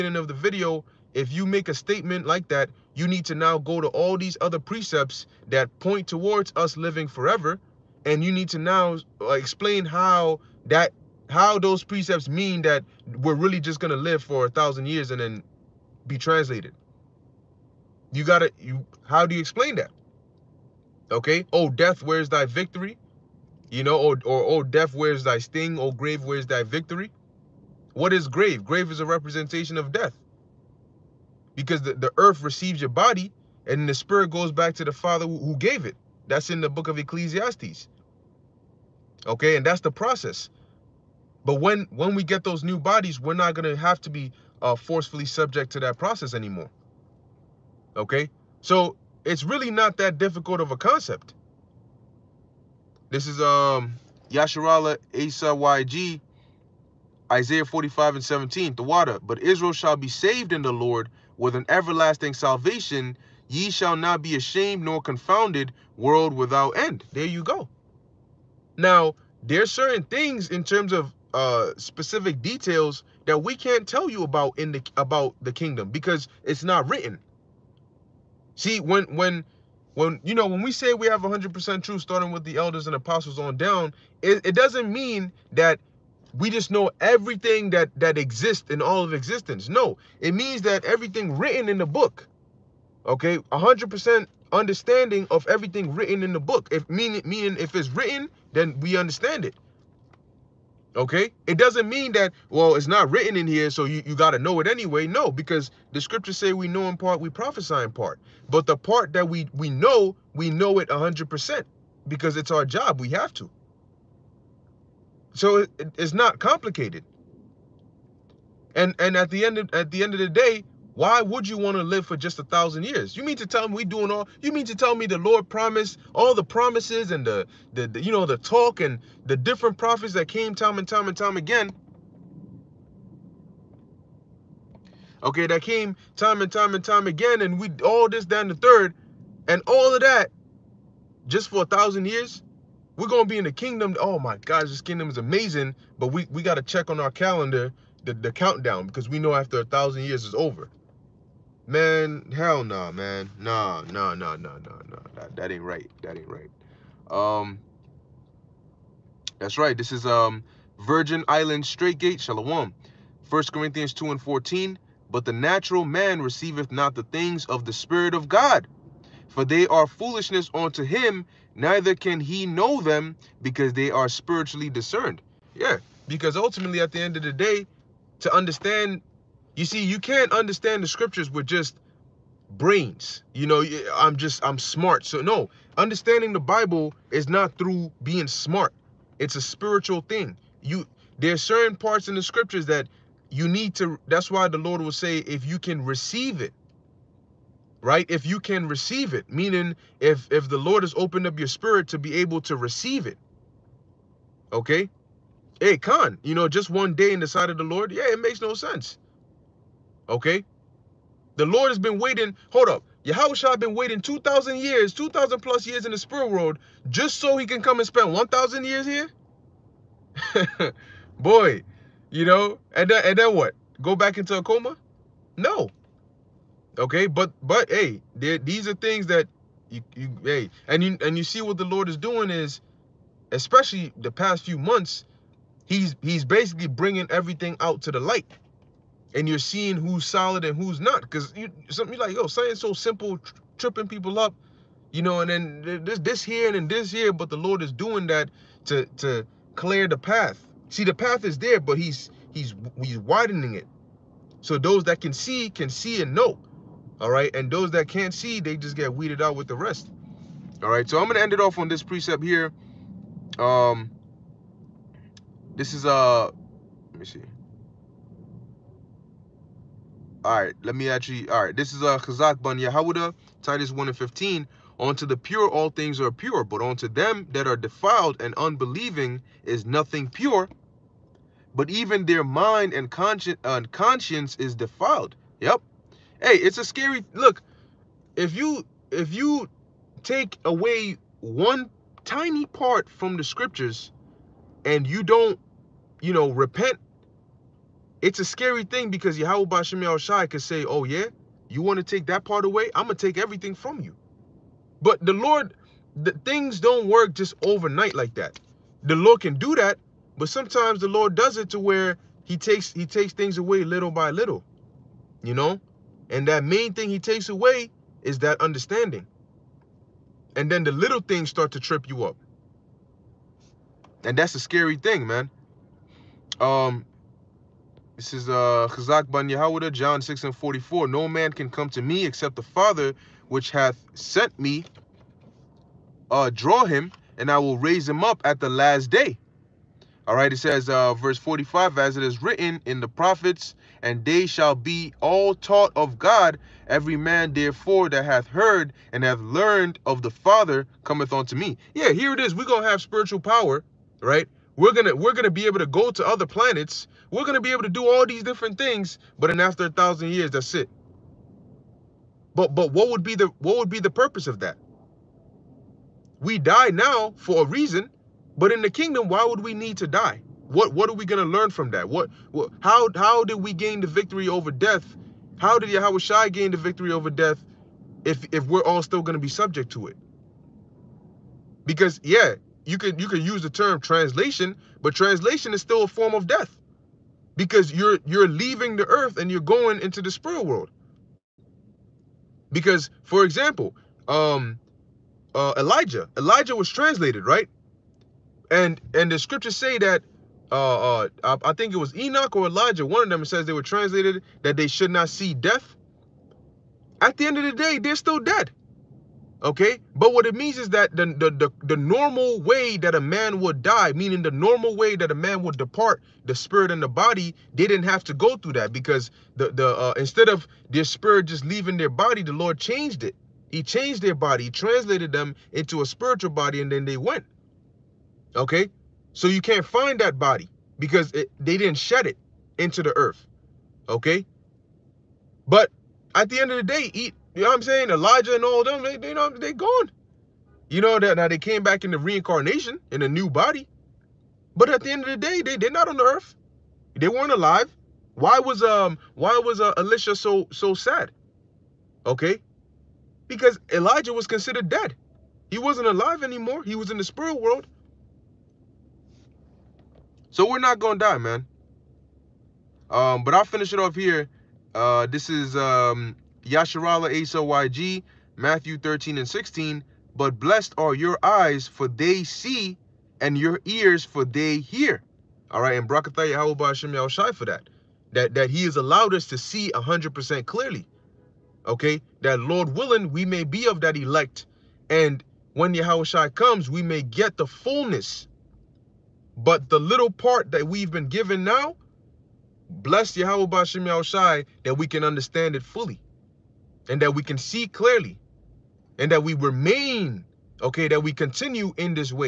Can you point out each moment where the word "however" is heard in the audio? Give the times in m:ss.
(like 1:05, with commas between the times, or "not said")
not said.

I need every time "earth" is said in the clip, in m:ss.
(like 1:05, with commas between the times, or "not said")
0:32, 6:28, 7:12, 7:26.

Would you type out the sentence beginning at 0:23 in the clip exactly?
You know, or oh, or oh death, where's thy sting?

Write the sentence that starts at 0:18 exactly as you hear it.
You gotta you how do you explain that?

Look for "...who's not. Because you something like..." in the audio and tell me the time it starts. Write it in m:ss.
4:00.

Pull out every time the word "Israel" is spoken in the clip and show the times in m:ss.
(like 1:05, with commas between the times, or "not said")
0:59.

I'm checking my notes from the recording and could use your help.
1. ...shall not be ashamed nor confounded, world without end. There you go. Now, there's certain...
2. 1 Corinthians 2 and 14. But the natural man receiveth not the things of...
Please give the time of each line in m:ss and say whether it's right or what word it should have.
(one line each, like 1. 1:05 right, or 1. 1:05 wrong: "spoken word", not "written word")
1. 1:03 right
2. 2:43 right.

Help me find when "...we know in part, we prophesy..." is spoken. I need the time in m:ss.
1:46.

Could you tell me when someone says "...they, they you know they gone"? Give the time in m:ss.
7:18.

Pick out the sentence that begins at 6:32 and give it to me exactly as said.
Because for example, um uh, Elijah, Elijah was translated, right?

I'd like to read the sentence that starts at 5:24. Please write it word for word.
And that's a scary thing, man.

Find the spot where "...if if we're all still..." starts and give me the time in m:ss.
6:18.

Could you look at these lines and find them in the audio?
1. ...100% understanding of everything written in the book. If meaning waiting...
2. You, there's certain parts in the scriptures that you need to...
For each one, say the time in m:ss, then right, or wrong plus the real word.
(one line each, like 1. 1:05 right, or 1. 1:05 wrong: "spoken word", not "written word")
1. 1:33 wrong: "meaning", not "waiting"
2. 3:10 right.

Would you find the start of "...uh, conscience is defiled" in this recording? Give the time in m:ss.
4:43.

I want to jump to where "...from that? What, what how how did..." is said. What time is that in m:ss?
6:11.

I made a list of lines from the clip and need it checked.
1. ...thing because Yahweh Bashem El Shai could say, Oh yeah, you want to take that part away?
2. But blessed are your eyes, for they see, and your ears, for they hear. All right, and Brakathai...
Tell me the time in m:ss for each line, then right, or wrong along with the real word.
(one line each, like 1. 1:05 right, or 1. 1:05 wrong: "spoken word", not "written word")
1. 4:58 right
2. 7:50 right.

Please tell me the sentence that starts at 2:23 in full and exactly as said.
Oh my gosh, this kingdom is amazing.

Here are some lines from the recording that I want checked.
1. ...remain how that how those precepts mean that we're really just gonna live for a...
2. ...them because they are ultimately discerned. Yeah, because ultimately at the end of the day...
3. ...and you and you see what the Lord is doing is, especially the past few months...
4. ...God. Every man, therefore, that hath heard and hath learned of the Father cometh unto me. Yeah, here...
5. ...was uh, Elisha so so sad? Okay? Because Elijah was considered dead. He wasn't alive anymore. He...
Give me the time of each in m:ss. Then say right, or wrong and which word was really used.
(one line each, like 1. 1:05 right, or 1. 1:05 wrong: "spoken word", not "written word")
1. 0:09 wrong: "explain", not "remain"
2. 2:52 wrong: "spiritually", not "ultimately"
3. 3:50 right
4. 5:45 right
5. 7:29 right.